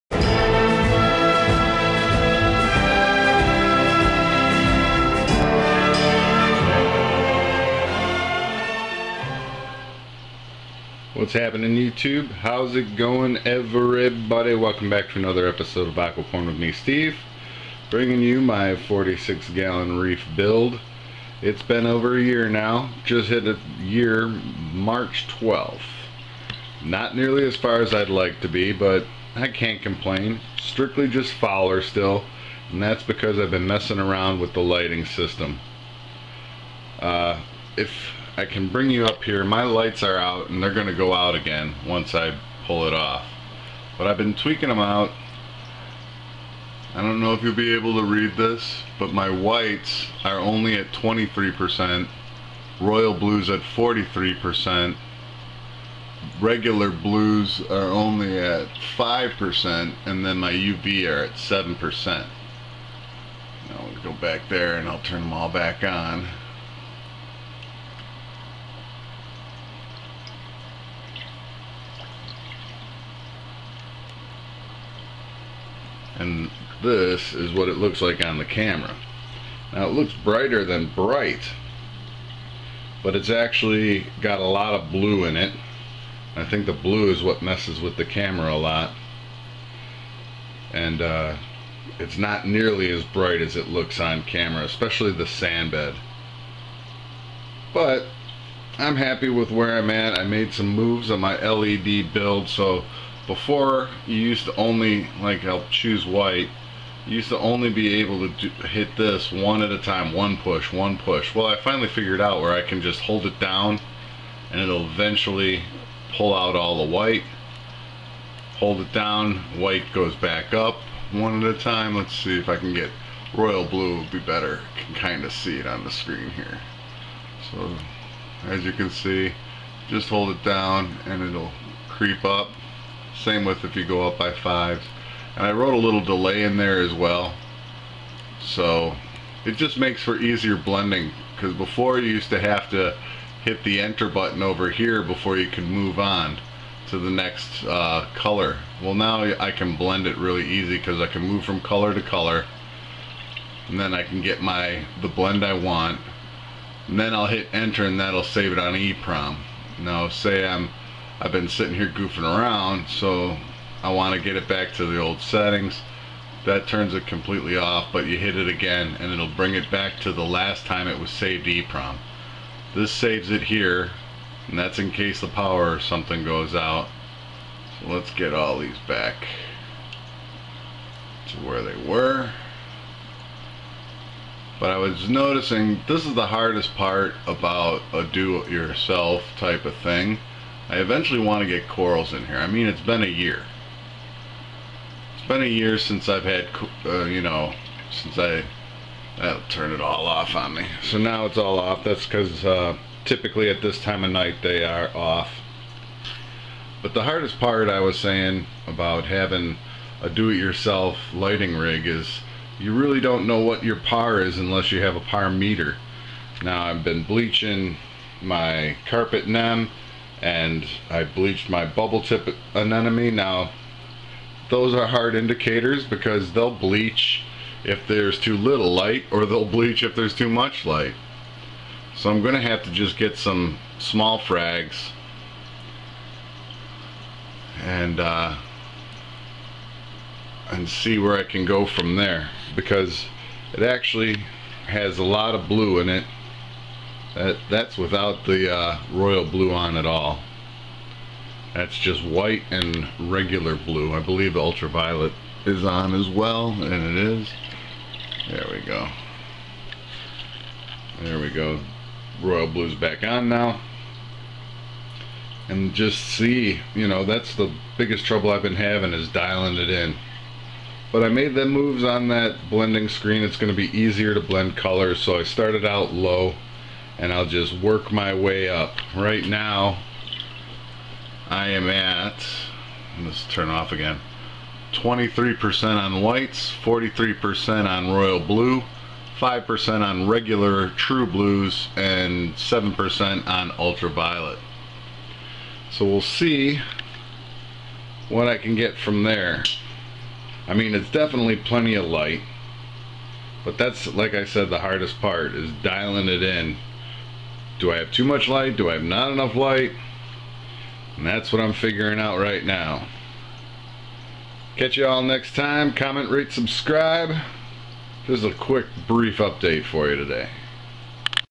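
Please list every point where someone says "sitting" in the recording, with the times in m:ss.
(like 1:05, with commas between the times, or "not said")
2:41.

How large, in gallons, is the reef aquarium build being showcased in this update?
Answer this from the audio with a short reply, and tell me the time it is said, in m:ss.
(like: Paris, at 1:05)
46 gallon, at 0:18.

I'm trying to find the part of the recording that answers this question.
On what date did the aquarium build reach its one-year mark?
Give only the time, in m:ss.
0:24.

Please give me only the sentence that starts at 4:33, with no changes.
It's going to be easier to blend colors, so I started out low and I'll just work my way up.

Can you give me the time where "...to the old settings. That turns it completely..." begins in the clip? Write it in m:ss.
2:44.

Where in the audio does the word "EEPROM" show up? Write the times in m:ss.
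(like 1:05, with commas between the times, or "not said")
2:38, 2:51.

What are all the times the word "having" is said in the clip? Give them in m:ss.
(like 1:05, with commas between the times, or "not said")
3:29, 4:28.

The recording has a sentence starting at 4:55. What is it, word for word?
So we'll see what I can get from there.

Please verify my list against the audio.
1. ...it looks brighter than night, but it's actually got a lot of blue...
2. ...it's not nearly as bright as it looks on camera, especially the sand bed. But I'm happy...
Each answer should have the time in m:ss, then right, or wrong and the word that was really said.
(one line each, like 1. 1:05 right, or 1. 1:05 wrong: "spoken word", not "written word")
1. 1:19 wrong: "bright", not "night"
2. 1:31 right.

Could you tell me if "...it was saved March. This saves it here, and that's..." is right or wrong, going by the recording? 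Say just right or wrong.
wrong.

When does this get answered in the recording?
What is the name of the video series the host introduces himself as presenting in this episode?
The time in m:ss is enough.
0:15.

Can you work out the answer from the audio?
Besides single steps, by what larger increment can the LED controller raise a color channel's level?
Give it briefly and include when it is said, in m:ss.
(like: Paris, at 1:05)
5, at 2:14.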